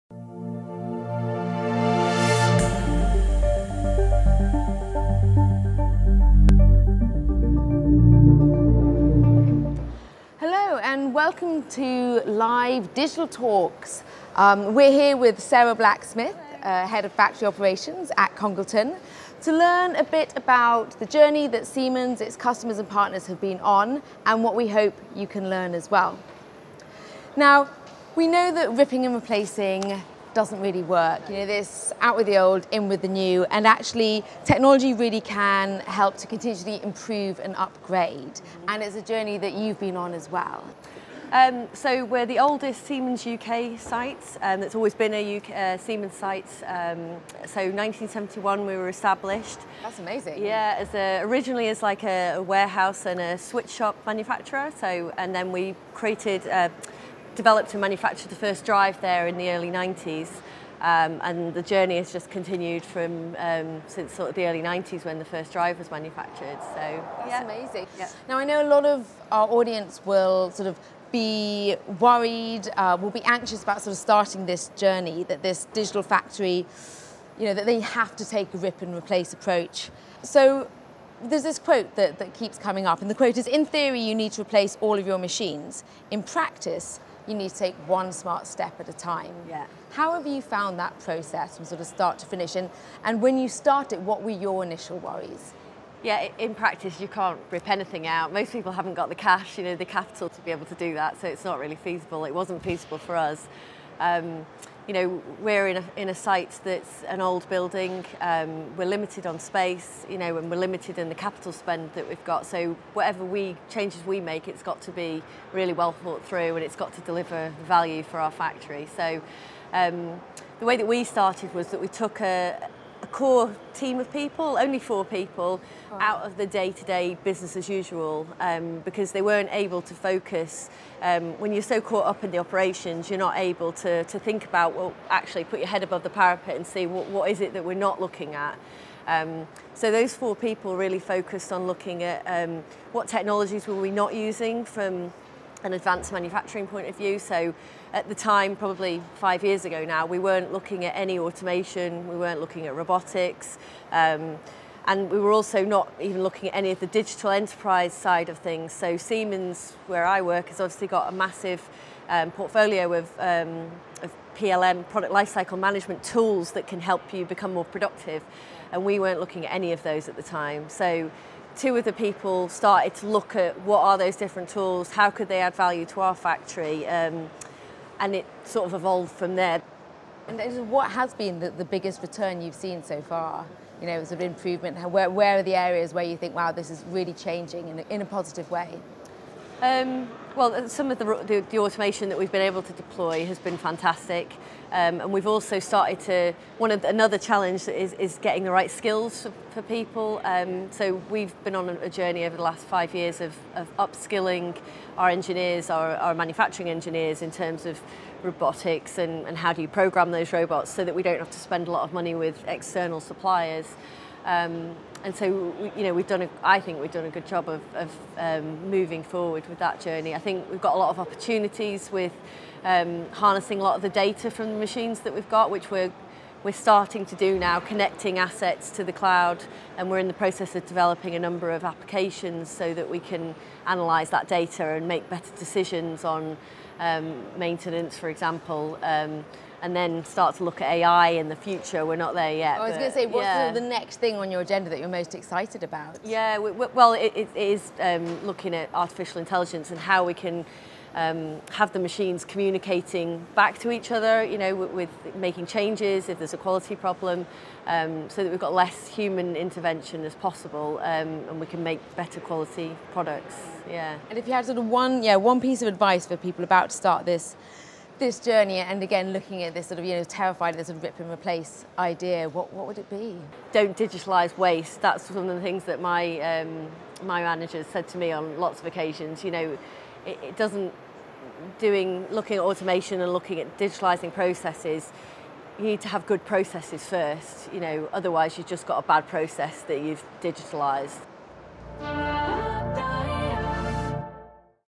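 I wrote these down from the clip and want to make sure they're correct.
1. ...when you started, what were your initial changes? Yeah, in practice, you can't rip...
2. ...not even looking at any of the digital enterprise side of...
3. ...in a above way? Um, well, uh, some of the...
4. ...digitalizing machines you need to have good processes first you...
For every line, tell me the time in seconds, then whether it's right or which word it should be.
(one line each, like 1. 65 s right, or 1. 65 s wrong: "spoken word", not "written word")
1. 93 s wrong: "worries", not "changes"
2. 155 s right
3. 187 s wrong: "positive", not "above"
4. 283 s wrong: "processes", not "machines".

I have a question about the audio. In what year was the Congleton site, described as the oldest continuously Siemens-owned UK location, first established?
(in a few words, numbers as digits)
1971.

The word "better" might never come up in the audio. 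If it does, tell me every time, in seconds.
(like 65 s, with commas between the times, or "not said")
235 s, 261 s.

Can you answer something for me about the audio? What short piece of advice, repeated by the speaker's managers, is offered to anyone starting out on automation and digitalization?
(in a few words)
Don't digitalize waste.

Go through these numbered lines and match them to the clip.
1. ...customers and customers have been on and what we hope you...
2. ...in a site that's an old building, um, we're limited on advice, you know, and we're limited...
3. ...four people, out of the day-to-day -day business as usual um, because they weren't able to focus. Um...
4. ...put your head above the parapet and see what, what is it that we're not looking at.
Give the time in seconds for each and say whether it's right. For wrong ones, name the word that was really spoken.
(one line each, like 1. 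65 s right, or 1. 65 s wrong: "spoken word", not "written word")
1. 22 s wrong: "partners", not "customers"
2. 105 s wrong: "space", not "advice"
3. 124 s right
4. 135 s right.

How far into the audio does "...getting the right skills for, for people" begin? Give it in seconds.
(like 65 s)
198 s.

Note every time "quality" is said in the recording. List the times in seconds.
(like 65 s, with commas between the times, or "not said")
256 s, 262 s.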